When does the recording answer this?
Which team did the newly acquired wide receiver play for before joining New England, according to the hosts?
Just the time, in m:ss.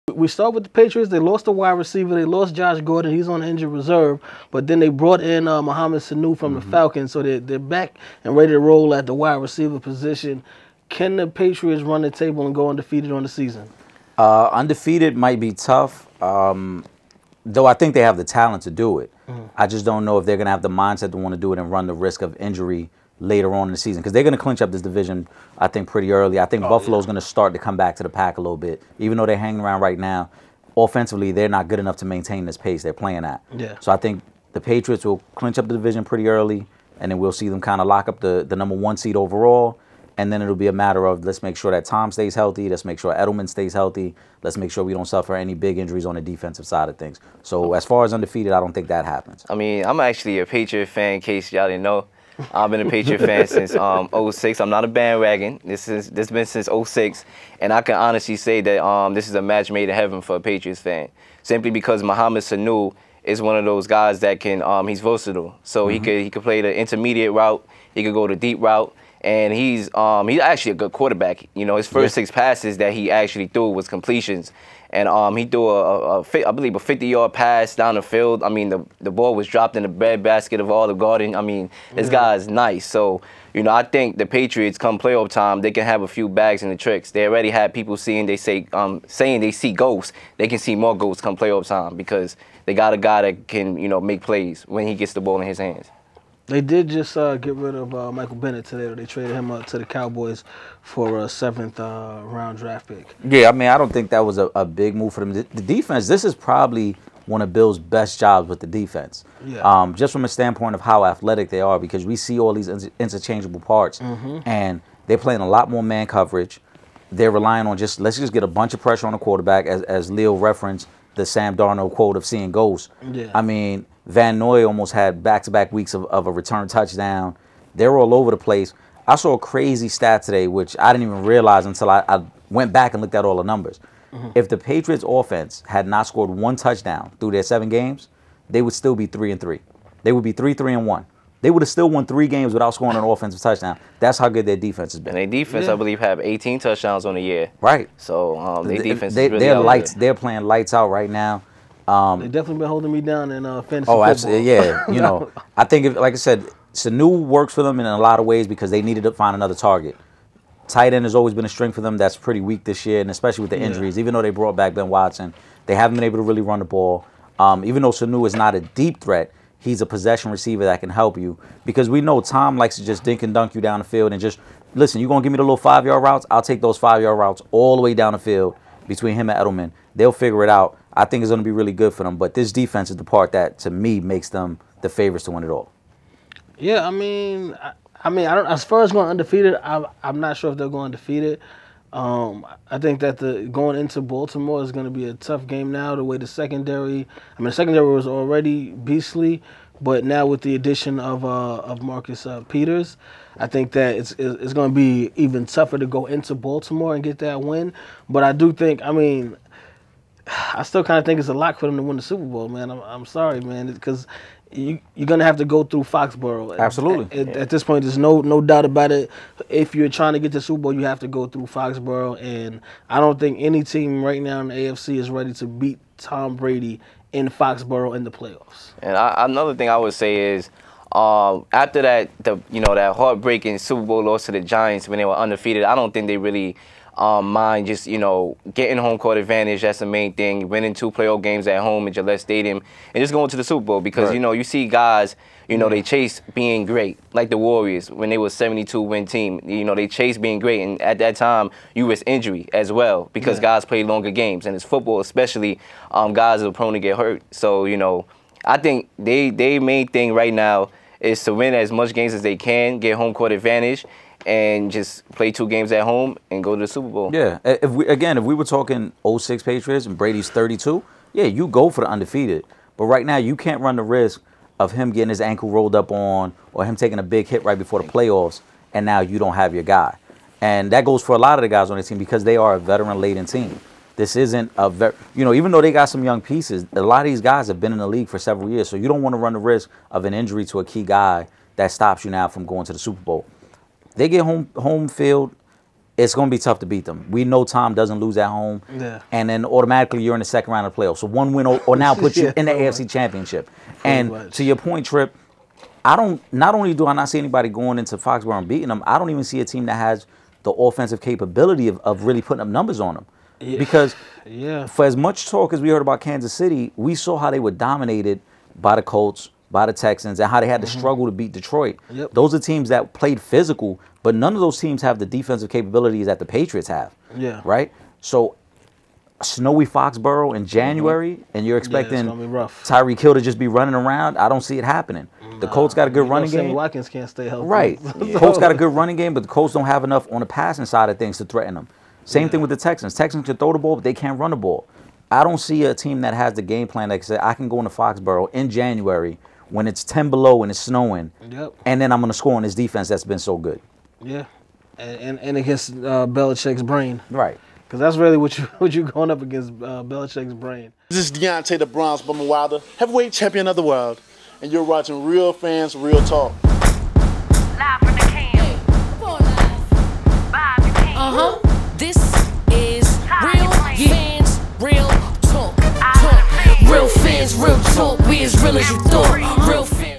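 0:06.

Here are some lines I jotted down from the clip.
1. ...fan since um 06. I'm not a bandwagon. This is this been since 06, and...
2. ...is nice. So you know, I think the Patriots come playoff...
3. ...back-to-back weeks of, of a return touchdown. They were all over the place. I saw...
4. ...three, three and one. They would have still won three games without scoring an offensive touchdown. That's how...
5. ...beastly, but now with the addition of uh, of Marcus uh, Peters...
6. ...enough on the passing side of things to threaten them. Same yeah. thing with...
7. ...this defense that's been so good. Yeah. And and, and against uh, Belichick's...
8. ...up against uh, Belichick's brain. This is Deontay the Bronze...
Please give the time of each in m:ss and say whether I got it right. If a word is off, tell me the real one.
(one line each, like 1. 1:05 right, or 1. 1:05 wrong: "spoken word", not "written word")
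1. 0:53 right
2. 1:22 right
3. 2:05 right
4. 2:20 right
5. 3:18 right
6. 5:39 right
7. 5:52 right
8. 5:59 right.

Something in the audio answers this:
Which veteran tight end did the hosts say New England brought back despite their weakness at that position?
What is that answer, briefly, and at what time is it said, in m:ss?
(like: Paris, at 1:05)
Ben Watson, at 2:44.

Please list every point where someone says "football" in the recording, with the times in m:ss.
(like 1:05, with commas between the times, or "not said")
2:33, 4:14.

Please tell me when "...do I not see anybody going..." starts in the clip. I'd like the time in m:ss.
5:06.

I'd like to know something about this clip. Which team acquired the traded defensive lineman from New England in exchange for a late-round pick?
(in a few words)
Cowboys.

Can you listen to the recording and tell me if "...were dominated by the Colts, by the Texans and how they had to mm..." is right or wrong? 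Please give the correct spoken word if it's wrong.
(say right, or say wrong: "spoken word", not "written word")
right.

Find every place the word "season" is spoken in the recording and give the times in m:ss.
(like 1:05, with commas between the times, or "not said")
0:13, 0:23.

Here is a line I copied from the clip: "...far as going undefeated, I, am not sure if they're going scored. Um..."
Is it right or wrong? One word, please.
wrong.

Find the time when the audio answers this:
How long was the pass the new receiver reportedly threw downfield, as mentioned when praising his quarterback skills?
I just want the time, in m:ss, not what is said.
1:16.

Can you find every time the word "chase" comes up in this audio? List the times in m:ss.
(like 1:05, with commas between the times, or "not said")
4:05, 4:09.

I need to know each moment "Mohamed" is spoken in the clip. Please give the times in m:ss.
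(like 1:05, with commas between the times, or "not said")
0:05, 1:02.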